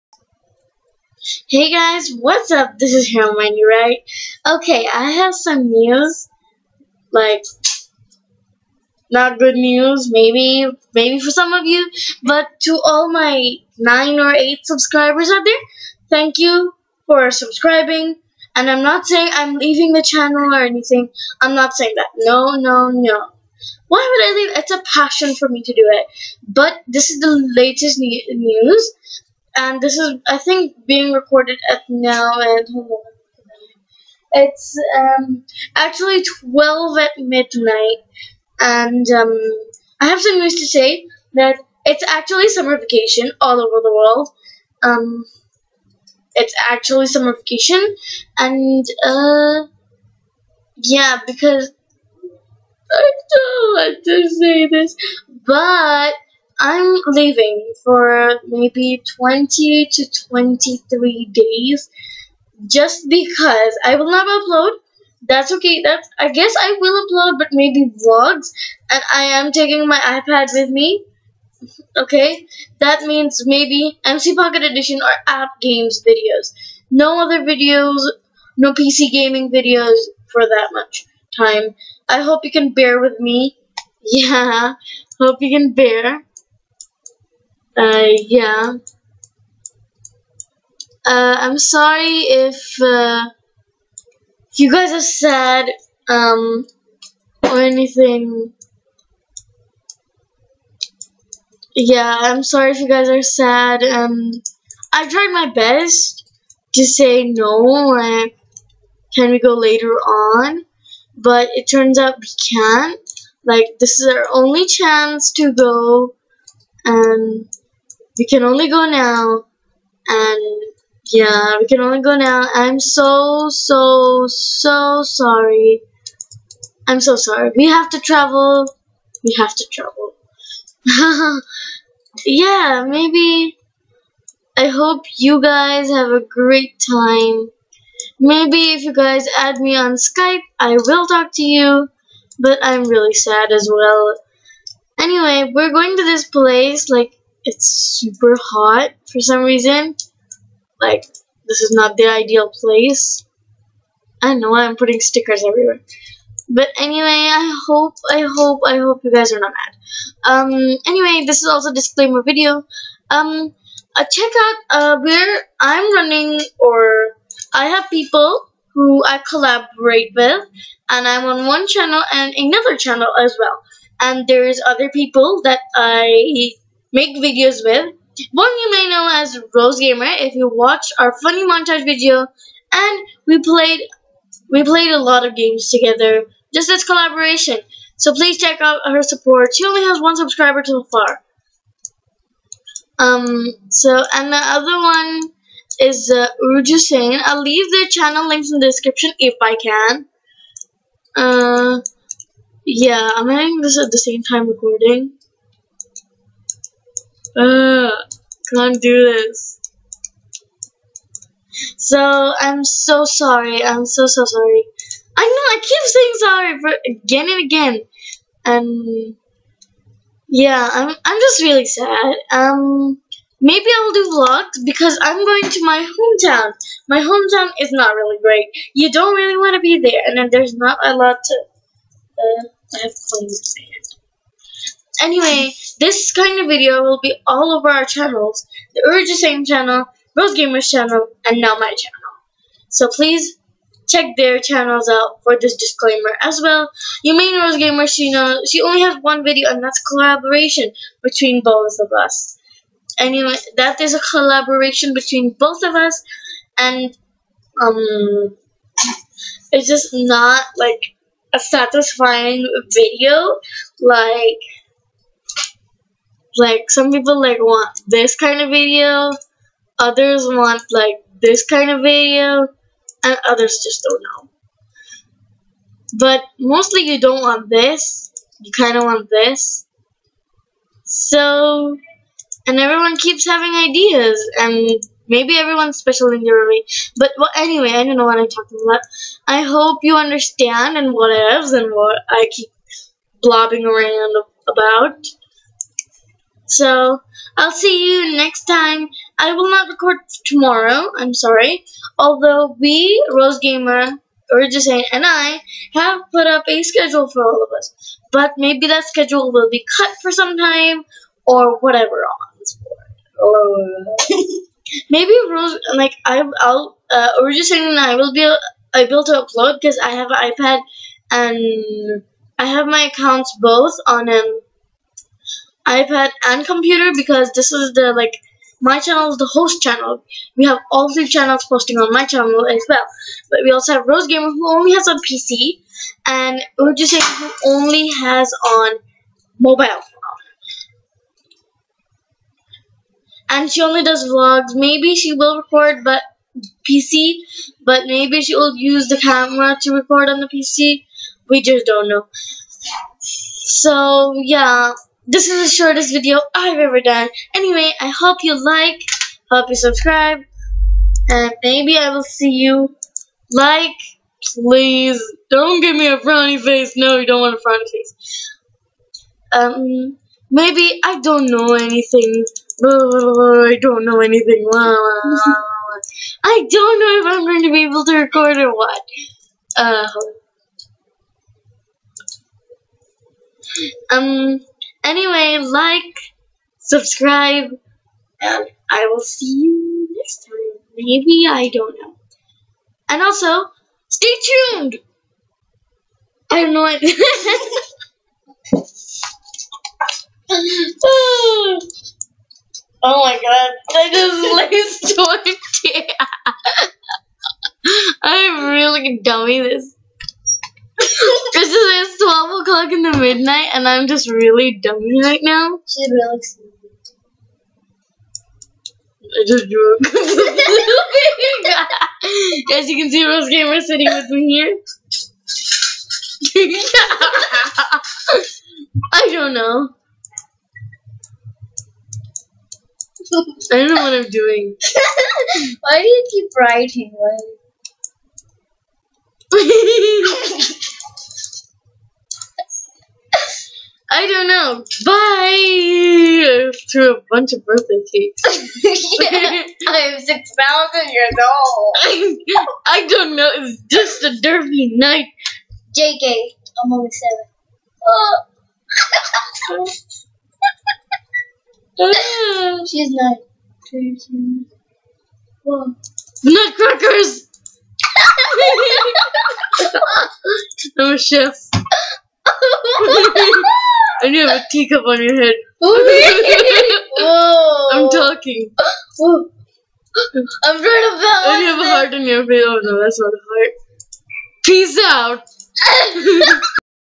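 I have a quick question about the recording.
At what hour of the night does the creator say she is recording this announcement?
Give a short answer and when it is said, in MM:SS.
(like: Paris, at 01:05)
12, at 00:36.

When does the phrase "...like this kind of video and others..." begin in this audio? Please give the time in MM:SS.
04:30.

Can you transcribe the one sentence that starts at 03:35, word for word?
I know, I keep saying sorry for again and again.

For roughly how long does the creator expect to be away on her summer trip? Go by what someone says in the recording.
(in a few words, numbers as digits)
20 to 23 days.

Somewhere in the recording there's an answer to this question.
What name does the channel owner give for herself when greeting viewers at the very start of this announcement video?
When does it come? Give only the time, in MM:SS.
00:03.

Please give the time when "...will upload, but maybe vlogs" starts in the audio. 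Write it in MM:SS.
01:06.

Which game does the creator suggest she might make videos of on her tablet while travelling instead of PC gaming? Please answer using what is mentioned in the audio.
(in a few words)
MC Pocket Edition.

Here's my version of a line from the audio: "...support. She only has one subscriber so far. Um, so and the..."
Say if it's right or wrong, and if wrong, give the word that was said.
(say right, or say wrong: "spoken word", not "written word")
right.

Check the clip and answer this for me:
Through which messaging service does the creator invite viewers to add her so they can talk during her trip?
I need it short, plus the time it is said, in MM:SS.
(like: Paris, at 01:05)
Skype, at 02:19.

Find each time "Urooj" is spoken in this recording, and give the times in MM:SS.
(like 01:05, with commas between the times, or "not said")
03:16, 03:58, 05:04.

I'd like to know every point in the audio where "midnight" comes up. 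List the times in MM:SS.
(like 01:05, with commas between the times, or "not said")
00:37, 06:52.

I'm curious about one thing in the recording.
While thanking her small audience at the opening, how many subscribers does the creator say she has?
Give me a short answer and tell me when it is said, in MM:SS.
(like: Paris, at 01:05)
9 or 8, at 00:13.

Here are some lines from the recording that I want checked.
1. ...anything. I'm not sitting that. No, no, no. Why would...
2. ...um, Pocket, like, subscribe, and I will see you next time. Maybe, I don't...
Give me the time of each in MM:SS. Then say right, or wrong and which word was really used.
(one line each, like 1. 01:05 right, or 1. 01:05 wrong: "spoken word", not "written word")
1. 00:20 wrong: "saying", not "sitting"
2. 06:23 wrong: "Anyway", not "Pocket".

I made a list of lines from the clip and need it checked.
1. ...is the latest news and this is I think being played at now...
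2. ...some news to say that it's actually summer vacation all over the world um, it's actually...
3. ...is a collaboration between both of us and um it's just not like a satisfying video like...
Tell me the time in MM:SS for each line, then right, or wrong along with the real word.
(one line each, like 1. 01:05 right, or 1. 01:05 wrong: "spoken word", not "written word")
1. 00:27 wrong: "recorded", not "played"
2. 00:40 right
3. 04:13 right.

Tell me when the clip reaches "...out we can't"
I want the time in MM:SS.
01:51.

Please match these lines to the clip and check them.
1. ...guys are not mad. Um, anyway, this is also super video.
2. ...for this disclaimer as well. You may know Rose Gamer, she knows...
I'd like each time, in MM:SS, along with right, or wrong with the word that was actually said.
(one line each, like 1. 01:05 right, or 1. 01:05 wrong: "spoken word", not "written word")
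1. 02:39 wrong: "disclaimer", not "super"
2. 04:05 right.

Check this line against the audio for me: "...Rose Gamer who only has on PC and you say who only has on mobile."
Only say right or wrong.
right.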